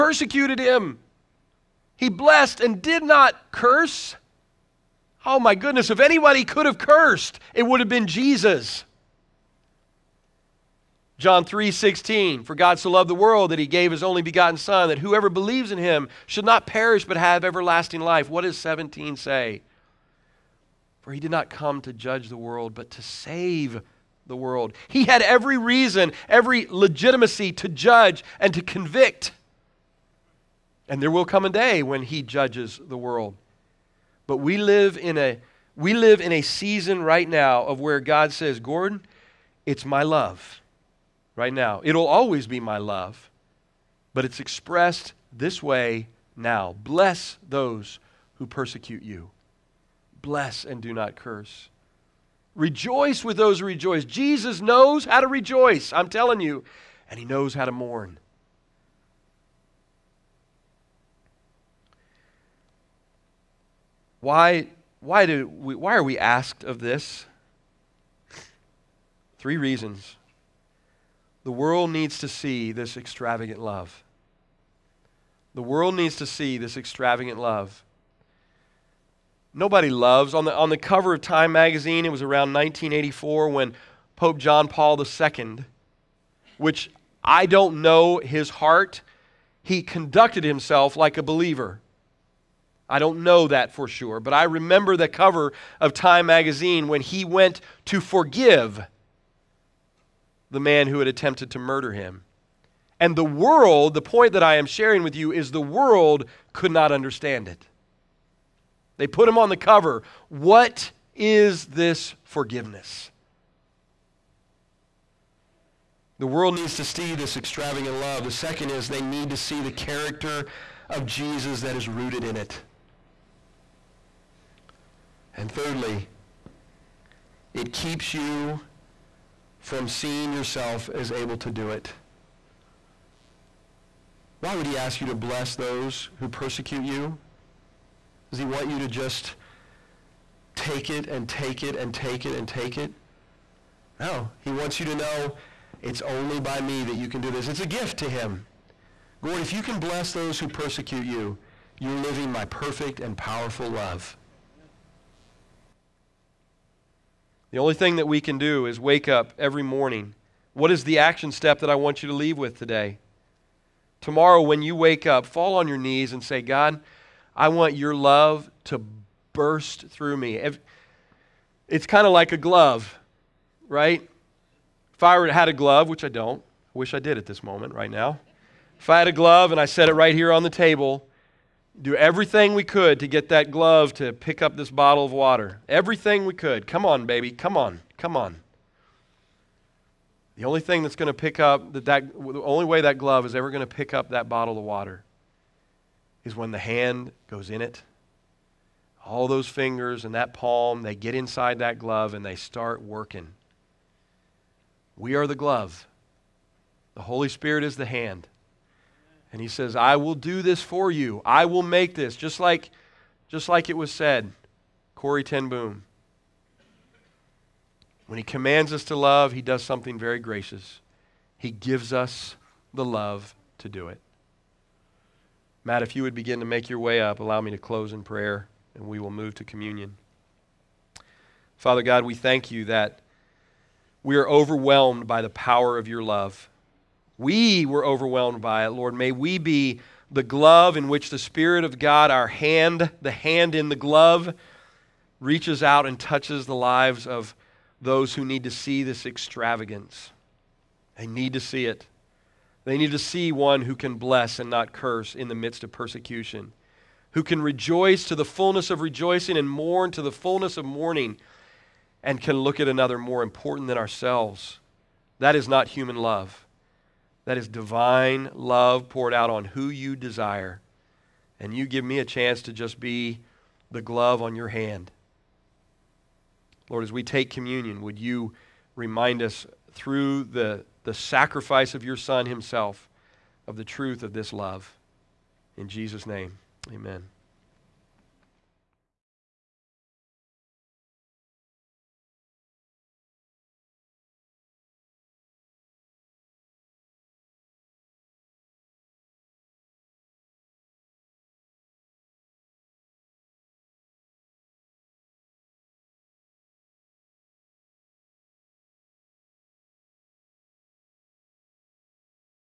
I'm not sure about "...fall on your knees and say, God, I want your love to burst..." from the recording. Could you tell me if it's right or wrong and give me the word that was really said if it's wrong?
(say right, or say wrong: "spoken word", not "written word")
right.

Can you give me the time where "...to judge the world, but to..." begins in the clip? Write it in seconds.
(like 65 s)
21 s.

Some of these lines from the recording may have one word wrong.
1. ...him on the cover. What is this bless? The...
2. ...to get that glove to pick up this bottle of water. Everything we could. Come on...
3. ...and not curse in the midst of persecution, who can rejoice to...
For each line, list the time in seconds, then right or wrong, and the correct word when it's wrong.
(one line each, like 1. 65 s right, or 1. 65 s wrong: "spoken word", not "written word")
1. 109 s wrong: "forgiveness", not "bless"
2. 182 s right
3. 254 s right.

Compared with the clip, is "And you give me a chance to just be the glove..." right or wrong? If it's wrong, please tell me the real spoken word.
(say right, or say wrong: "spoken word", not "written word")
right.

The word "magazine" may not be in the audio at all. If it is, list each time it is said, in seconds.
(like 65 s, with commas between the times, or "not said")
81 s, 96 s.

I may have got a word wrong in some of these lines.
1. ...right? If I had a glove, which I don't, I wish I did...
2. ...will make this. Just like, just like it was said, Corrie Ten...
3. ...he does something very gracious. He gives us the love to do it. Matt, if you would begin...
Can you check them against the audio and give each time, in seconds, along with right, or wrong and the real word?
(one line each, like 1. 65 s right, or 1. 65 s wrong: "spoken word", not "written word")
1. 173 s right
2. 211 s right
3. 219 s right.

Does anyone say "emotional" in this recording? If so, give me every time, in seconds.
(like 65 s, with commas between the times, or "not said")
not said.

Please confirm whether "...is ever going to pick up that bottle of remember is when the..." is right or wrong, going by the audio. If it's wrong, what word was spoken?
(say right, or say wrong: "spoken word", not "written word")
wrong: "water", not "remember".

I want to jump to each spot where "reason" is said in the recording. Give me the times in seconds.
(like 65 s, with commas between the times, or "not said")
25 s, 69 s.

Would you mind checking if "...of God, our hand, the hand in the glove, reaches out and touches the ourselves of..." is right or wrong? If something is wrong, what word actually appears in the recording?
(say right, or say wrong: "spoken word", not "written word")
wrong: "lives", not "ourselves".